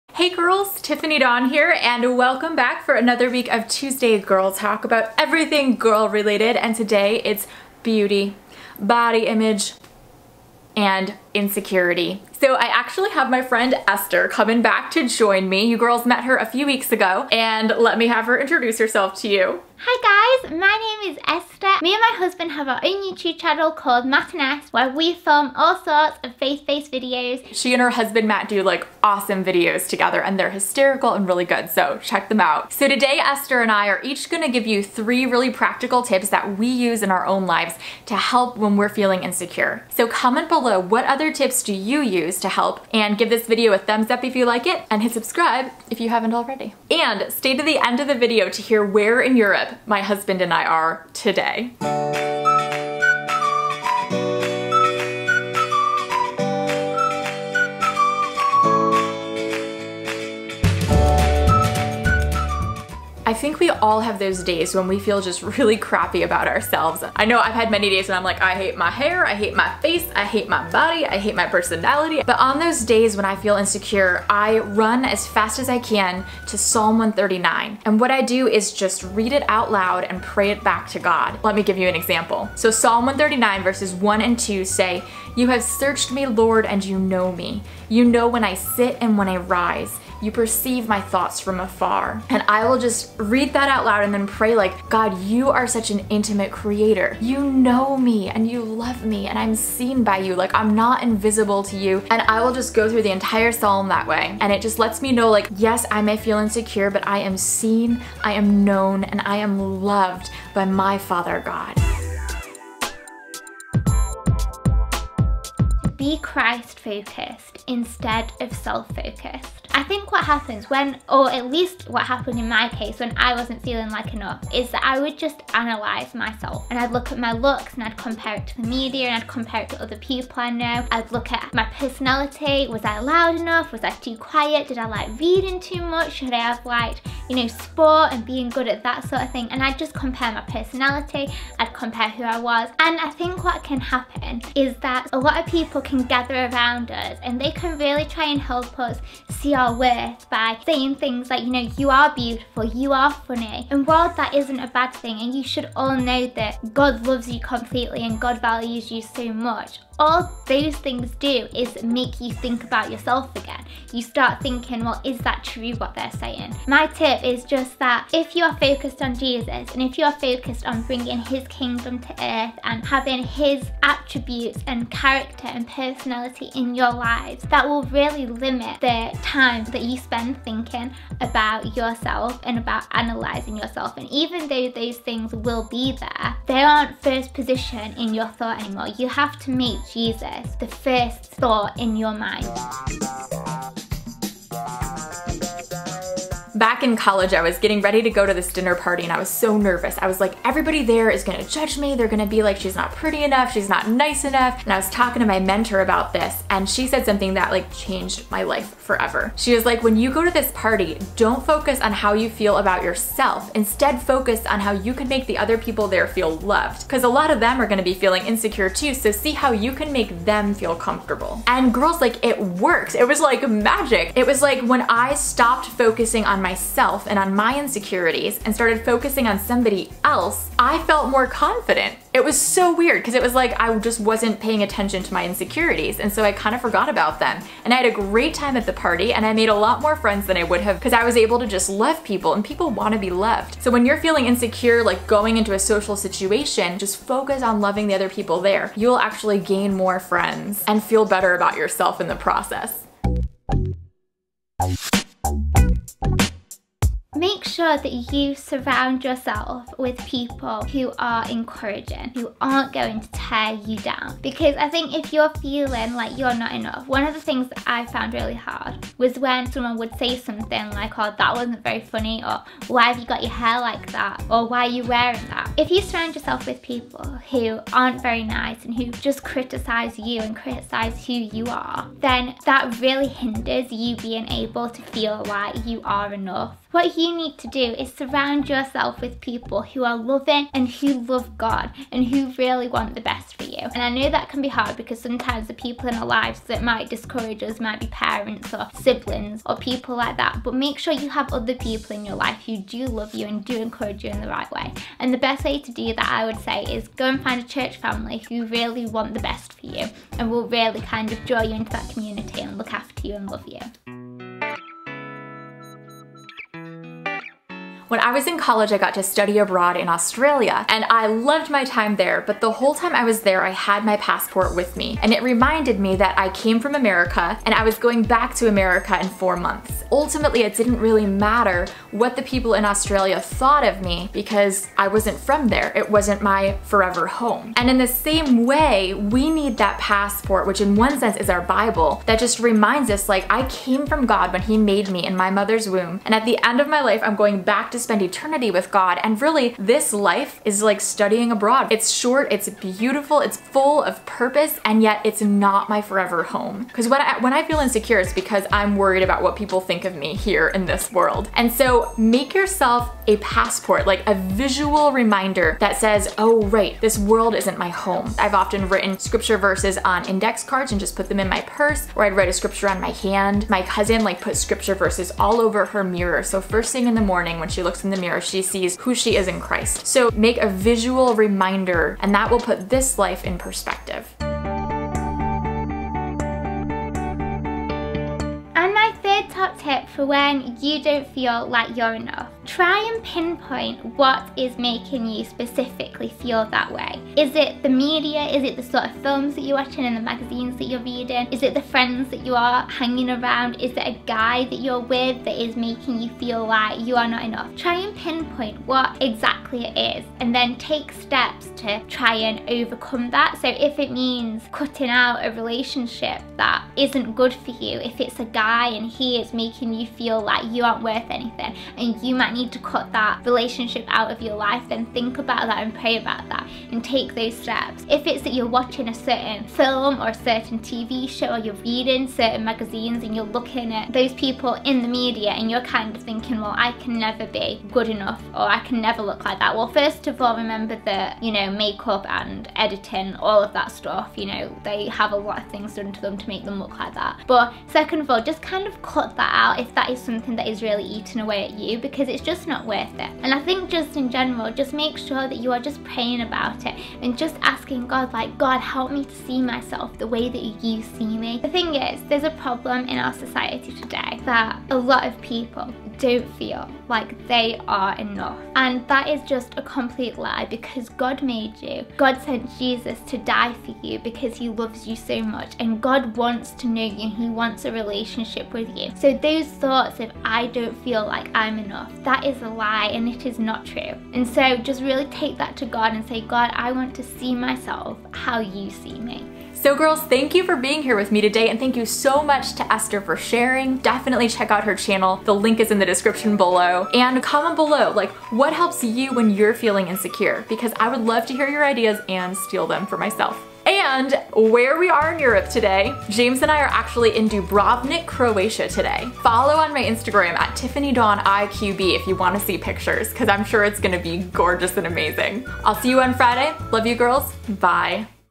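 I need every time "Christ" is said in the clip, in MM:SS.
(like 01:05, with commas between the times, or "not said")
01:56, 06:19.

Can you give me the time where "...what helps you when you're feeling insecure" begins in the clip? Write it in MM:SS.
08:18.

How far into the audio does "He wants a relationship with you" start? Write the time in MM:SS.
07:57.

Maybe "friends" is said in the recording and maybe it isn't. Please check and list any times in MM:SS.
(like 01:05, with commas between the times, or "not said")
00:13, 03:59, 04:10, 06:41.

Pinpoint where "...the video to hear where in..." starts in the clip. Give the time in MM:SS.
00:48.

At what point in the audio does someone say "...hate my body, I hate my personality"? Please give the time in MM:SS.
01:10.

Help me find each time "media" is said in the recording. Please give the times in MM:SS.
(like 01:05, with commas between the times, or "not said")
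02:08, 06:37, 07:14.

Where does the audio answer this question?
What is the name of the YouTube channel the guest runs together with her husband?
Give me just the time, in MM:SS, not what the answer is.
00:24.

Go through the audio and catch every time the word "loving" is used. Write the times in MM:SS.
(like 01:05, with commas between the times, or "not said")
04:07, 04:49.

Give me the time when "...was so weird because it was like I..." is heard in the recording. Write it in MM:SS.
03:52.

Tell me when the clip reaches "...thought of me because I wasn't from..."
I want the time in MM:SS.
05:33.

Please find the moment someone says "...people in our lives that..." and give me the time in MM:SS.
04:55.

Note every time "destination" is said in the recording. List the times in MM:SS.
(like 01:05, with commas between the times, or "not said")
not said.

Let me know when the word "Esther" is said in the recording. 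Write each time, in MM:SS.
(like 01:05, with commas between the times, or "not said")
00:13, 00:21, 00:33, 08:12.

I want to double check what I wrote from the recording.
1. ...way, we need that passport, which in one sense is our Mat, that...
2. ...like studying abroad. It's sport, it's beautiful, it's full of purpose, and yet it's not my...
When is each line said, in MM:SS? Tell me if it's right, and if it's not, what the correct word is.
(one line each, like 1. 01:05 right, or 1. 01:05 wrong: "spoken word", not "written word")
1. 05:38 wrong: "Bible", not "Mat"
2. 05:50 wrong: "short", not "sport".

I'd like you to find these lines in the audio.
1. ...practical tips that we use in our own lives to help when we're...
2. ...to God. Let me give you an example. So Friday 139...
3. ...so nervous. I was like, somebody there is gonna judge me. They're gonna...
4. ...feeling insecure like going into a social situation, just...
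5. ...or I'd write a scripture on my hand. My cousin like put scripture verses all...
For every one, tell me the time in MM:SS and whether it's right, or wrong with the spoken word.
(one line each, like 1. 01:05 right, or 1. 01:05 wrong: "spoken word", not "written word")
1. 00:35 right
2. 01:20 wrong: "Psalm", not "Friday"
3. 03:19 wrong: "everybody", not "somebody"
4. 04:04 right
5. 06:11 right.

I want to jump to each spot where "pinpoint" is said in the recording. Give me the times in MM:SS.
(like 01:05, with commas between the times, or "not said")
06:33, 06:47.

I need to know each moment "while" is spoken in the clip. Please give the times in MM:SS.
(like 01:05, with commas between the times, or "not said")
02:33.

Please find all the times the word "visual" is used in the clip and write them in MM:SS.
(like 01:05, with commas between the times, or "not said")
06:04, 06:20.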